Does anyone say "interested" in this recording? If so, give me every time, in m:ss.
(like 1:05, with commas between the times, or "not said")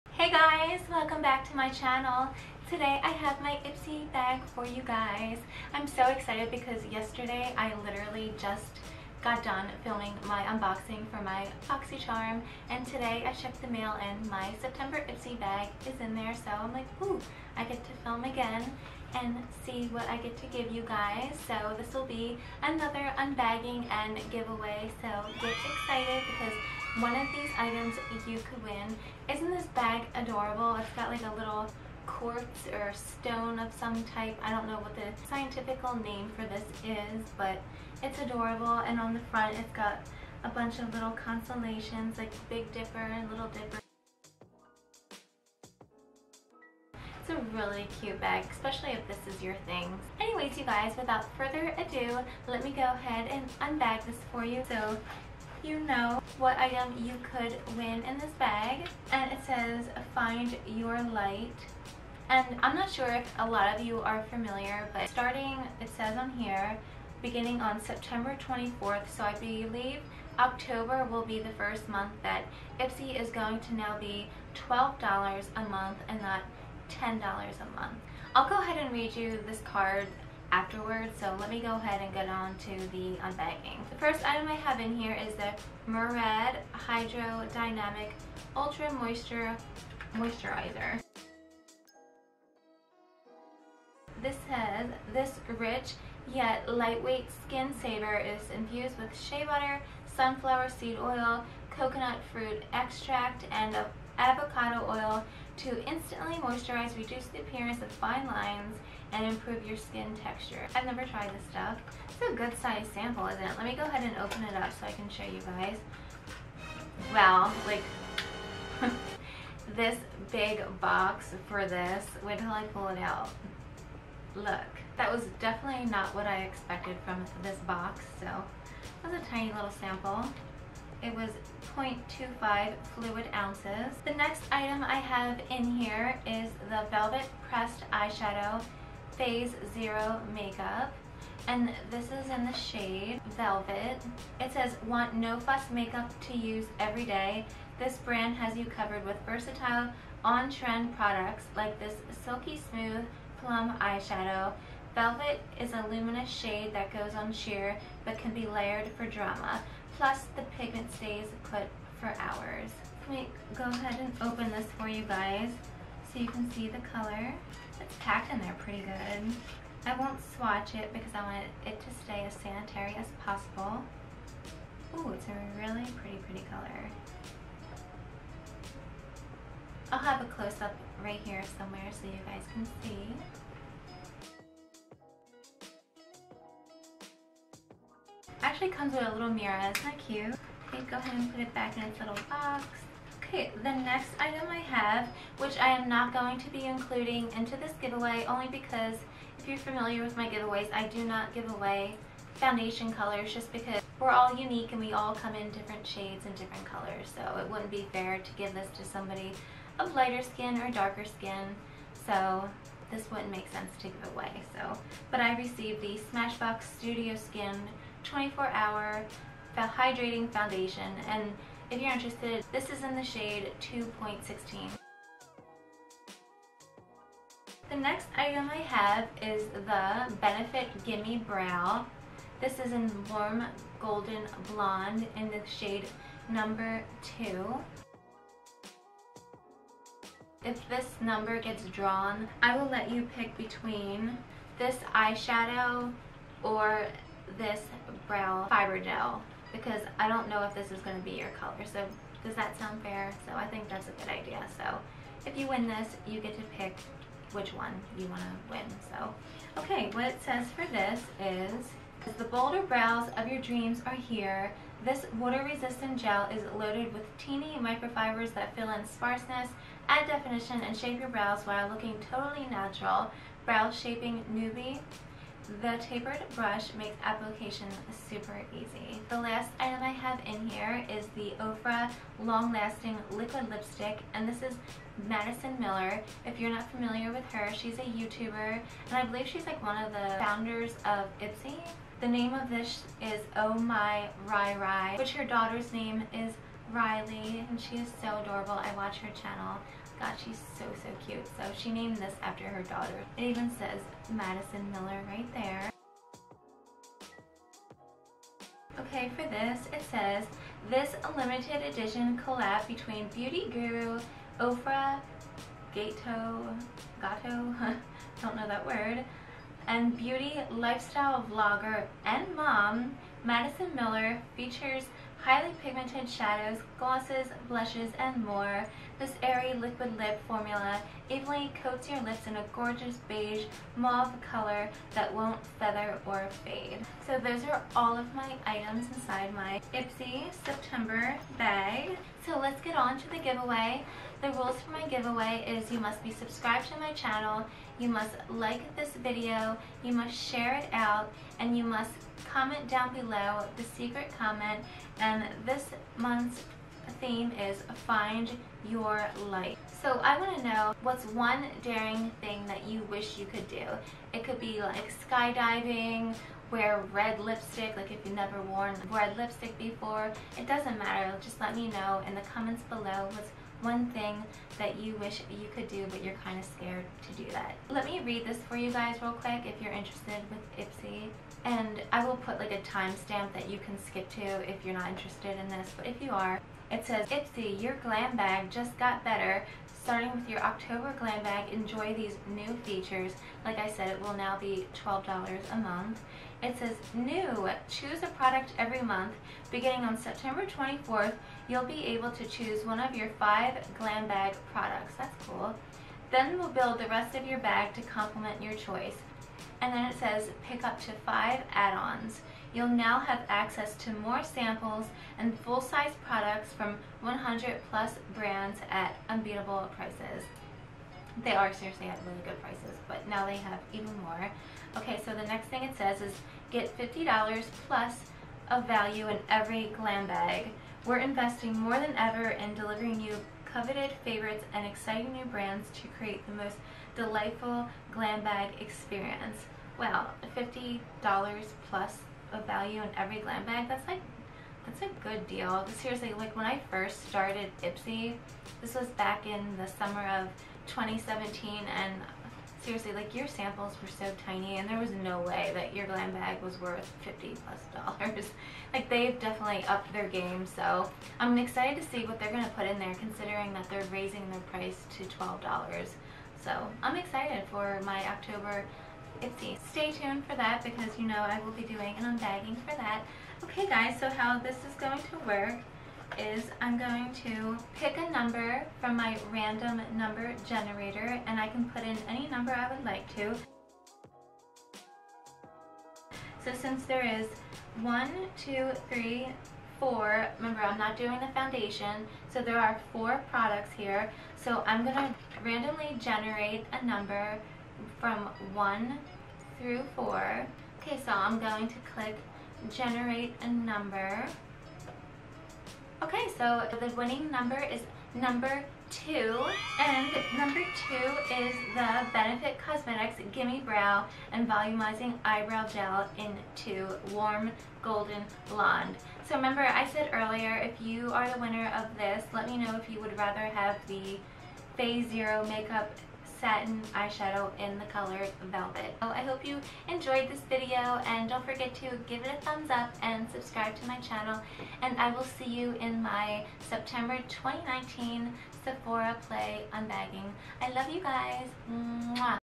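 3:41, 6:19, 6:24.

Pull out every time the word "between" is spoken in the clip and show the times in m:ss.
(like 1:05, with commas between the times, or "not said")
4:03, 5:12.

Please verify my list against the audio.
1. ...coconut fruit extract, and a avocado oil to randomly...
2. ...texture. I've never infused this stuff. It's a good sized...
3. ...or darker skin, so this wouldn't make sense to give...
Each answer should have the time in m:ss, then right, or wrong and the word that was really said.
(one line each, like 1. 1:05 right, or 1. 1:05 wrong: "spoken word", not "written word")
1. 1:41 wrong: "instantly", not "randomly"
2. 1:50 wrong: "tried", not "infused"
3. 3:30 right.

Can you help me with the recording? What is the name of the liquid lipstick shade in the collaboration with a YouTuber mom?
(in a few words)
Oh My Rai Rai.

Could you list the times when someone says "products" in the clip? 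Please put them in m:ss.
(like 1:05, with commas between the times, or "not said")
2:30, 6:38, 6:44, 6:56, 8:13.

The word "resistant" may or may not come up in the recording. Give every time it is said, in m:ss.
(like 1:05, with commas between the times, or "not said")
4:25.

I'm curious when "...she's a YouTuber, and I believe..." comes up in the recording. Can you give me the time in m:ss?
4:47.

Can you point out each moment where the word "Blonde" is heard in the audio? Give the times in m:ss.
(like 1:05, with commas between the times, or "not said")
3:54, 8:38.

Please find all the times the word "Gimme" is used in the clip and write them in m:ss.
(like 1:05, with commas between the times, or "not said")
3:50, 8:33.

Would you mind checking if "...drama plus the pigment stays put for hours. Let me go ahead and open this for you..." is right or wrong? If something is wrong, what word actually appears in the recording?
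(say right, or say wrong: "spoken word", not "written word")
right.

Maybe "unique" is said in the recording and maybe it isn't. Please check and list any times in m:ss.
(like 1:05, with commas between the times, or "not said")
3:24.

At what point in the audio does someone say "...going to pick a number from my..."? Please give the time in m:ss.
7:56.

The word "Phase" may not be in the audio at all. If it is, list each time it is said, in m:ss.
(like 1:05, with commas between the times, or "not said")
2:19, 8:44.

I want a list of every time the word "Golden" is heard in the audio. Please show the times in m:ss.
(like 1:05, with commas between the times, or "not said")
3:53, 8:37.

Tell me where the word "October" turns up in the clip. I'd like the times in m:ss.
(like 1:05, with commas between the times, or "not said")
1:10, 6:30, 7:48.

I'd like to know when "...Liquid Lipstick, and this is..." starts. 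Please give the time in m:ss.
4:43.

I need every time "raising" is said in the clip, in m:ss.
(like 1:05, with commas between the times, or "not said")
7:43.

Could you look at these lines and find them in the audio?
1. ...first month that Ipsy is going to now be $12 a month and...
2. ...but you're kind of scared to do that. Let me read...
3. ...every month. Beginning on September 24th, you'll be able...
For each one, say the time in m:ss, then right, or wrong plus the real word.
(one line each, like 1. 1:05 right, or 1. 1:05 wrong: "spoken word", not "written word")
1. 1:11 right
2. 6:15 right
3. 6:38 right.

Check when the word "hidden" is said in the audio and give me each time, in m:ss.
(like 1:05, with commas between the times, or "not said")
not said.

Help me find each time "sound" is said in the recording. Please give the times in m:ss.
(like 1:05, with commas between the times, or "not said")
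4:12.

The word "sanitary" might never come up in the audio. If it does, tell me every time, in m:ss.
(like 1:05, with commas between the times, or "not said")
2:52.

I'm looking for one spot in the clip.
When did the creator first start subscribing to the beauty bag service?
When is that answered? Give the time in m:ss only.
7:29.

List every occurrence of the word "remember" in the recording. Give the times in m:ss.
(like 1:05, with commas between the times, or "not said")
8:10, 8:39.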